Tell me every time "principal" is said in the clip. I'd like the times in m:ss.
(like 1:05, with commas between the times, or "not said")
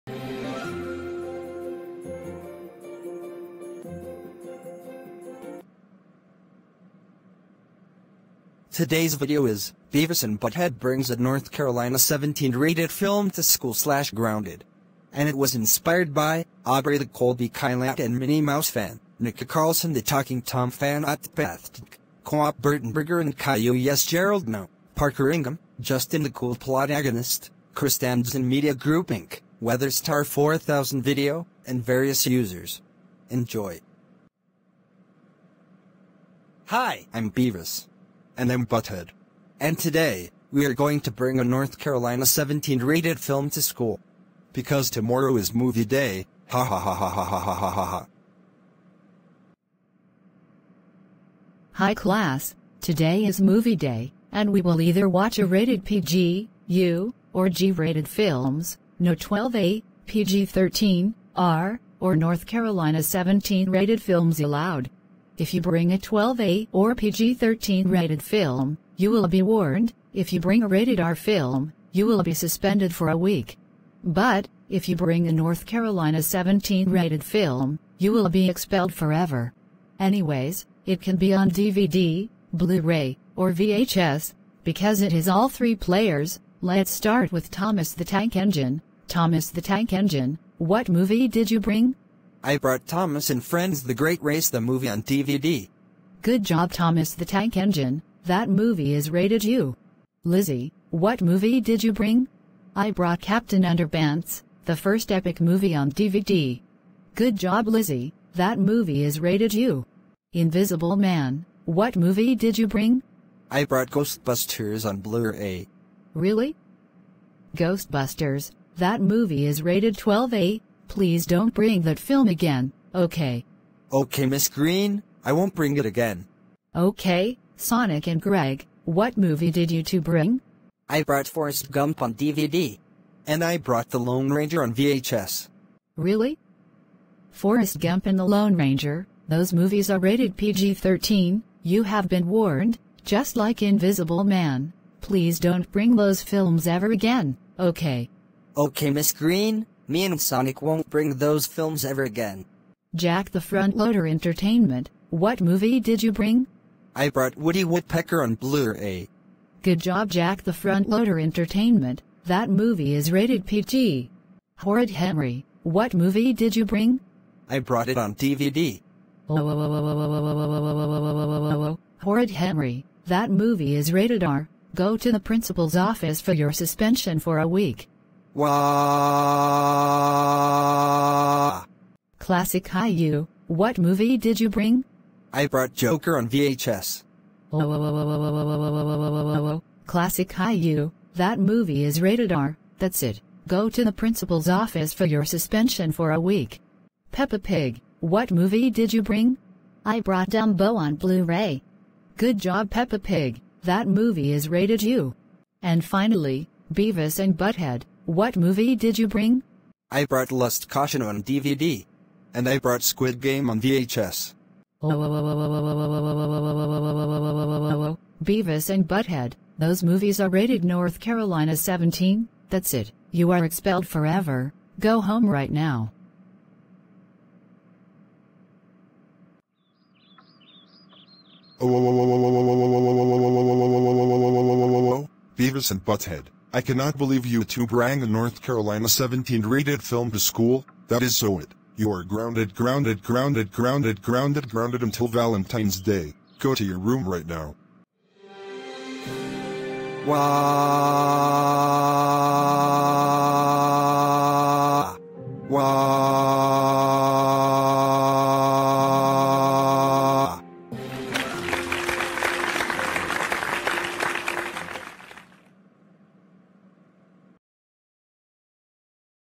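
2:55, 3:13.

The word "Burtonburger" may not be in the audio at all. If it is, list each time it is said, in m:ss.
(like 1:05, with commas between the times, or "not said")
0:22.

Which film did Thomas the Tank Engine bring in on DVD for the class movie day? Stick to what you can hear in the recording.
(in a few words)
The Great Race.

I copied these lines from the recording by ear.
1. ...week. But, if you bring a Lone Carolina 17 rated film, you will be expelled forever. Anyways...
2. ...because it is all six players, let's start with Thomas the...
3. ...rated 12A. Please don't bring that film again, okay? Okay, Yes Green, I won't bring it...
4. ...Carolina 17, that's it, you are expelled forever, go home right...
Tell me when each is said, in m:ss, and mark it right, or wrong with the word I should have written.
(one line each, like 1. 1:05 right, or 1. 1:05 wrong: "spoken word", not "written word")
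1. 1:13 wrong: "North", not "Lone"
2. 1:24 wrong: "three", not "six"
3. 1:59 wrong: "Miss", not "Yes"
4. 3:40 right.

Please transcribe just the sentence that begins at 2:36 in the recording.
I brought Woody Woodpecker on Blu-ray.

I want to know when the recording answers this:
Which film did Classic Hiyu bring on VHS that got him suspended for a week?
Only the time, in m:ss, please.
3:05.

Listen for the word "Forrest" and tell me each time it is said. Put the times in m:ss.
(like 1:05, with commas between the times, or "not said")
2:11, 2:17.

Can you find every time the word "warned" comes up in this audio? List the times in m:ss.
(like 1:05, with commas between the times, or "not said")
1:09, 2:22.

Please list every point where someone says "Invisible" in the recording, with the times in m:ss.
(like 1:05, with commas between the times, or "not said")
1:50, 2:23.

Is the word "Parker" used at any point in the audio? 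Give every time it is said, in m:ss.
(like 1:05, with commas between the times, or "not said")
0:24.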